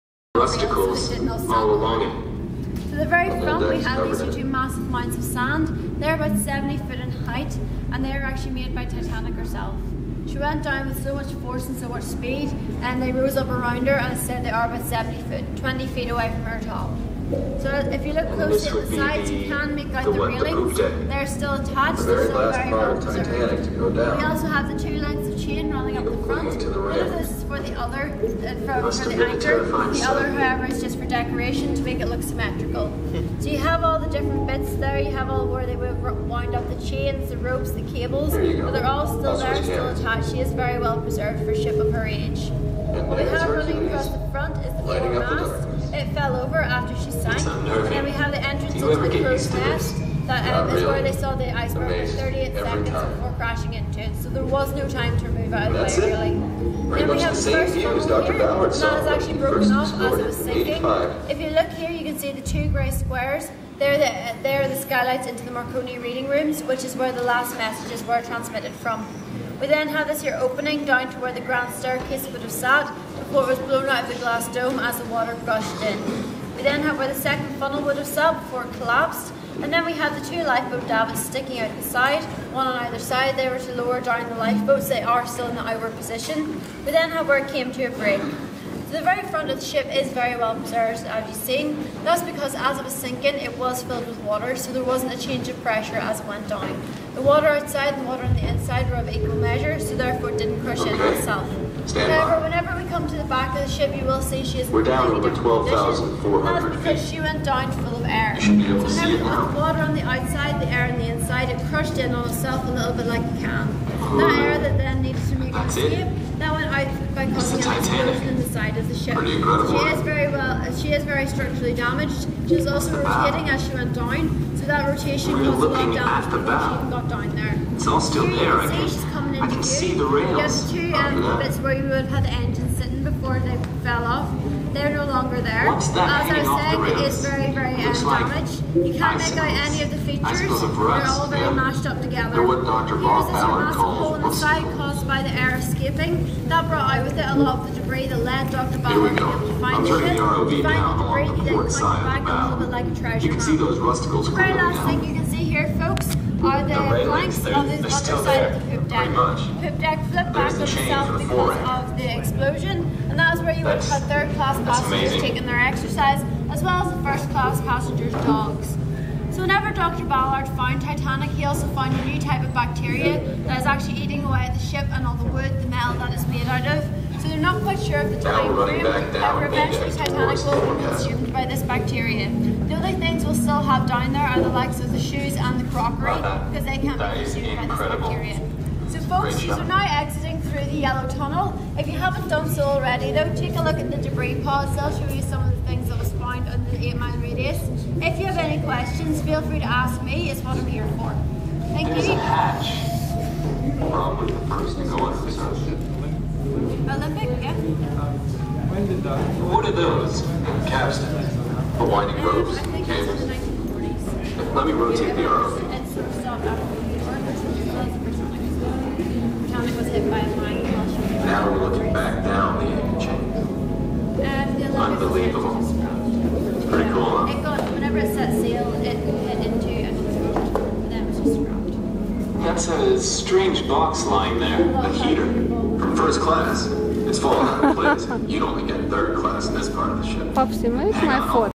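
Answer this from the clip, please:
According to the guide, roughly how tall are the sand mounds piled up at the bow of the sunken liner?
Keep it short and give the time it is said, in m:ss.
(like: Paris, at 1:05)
70 foot, at 0:06.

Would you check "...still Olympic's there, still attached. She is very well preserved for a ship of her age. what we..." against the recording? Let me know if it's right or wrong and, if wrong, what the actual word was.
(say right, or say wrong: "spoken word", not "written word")
wrong: "That", not "Olympic".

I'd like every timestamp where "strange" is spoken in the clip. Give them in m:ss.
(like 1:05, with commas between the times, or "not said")
3:53.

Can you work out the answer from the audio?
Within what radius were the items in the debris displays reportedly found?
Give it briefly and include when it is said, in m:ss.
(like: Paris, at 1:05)
8 mile, at 3:16.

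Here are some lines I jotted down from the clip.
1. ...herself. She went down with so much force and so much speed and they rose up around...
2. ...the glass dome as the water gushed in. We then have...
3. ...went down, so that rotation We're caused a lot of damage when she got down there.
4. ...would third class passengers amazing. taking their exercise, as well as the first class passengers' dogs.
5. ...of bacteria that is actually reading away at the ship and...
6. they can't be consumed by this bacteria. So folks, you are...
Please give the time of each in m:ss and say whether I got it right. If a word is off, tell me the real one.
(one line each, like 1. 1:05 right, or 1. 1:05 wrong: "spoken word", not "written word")
1. 0:09 right
2. 1:14 right
3. 2:03 right
4. 2:43 right
5. 2:52 wrong: "eating", not "reading"
6. 3:06 right.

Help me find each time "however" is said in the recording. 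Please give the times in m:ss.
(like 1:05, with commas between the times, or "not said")
0:30, 1:42.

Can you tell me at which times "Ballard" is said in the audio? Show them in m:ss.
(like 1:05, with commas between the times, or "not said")
0:58, 2:28, 2:50.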